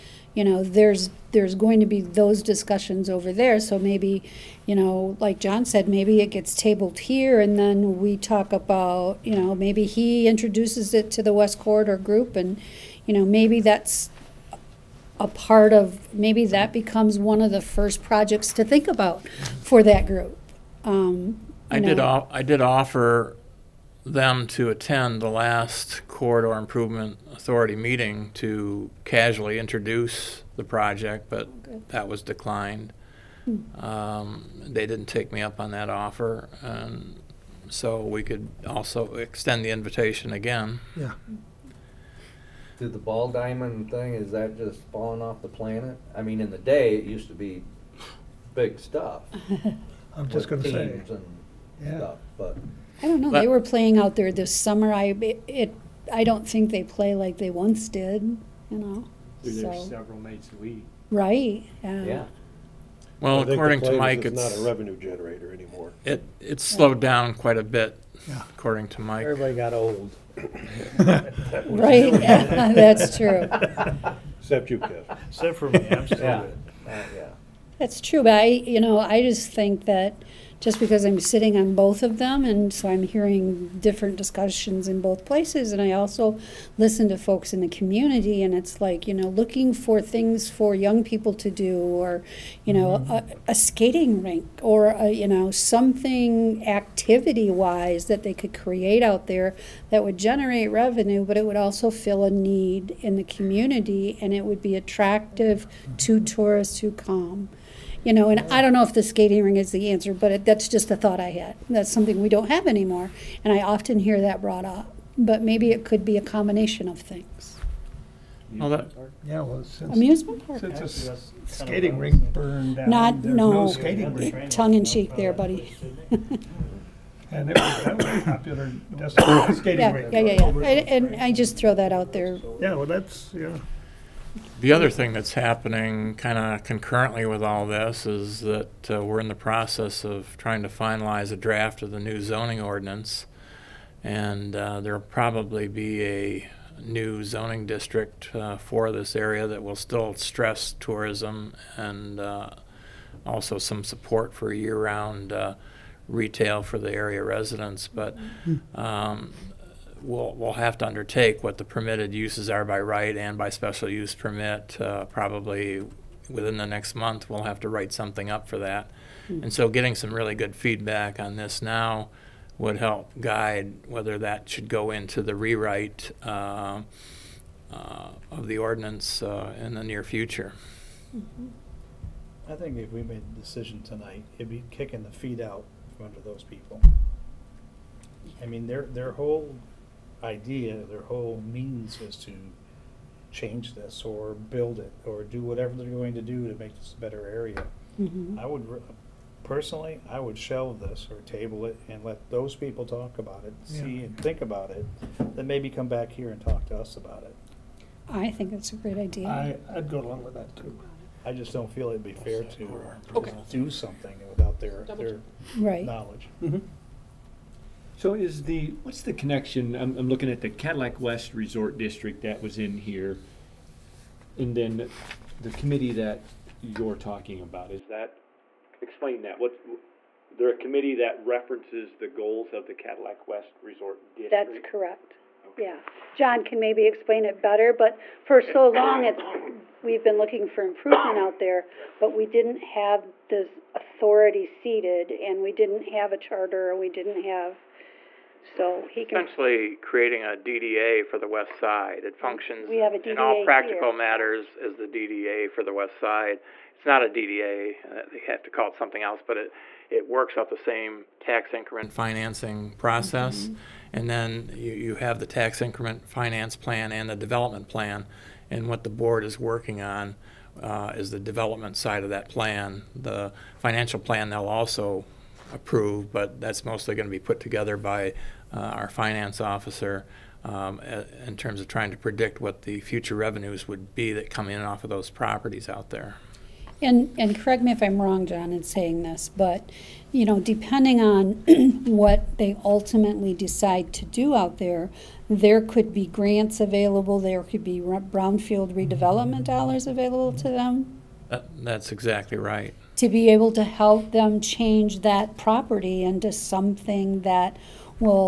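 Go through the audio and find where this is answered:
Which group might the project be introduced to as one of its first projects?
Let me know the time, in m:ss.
0:11.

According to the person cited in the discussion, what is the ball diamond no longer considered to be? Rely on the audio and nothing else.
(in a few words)
A revenue generator.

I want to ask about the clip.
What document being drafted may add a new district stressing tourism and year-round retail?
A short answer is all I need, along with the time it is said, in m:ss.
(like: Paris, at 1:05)
Zoning ordinance, at 2:22.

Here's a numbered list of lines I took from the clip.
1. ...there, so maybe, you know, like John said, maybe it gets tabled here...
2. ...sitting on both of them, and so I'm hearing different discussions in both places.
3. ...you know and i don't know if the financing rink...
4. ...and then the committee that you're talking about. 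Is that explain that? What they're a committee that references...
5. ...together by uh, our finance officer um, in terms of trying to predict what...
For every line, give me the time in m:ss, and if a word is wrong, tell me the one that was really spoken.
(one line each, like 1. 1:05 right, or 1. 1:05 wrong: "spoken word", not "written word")
1. 0:03 right
2. 1:21 right
3. 1:48 wrong: "skating", not "financing"
4. 3:44 right
5. 4:37 right.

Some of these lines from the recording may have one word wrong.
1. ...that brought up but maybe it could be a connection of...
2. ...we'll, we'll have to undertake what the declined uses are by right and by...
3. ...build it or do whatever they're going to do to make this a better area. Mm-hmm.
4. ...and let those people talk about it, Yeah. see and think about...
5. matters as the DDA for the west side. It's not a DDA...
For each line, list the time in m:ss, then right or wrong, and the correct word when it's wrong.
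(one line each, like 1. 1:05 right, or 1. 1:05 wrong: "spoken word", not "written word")
1. 1:54 wrong: "combination", not "connection"
2. 2:40 wrong: "permitted", not "declined"
3. 3:14 right
4. 3:21 right
5. 4:13 right.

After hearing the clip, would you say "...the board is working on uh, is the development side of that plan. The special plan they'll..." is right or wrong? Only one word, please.
wrong.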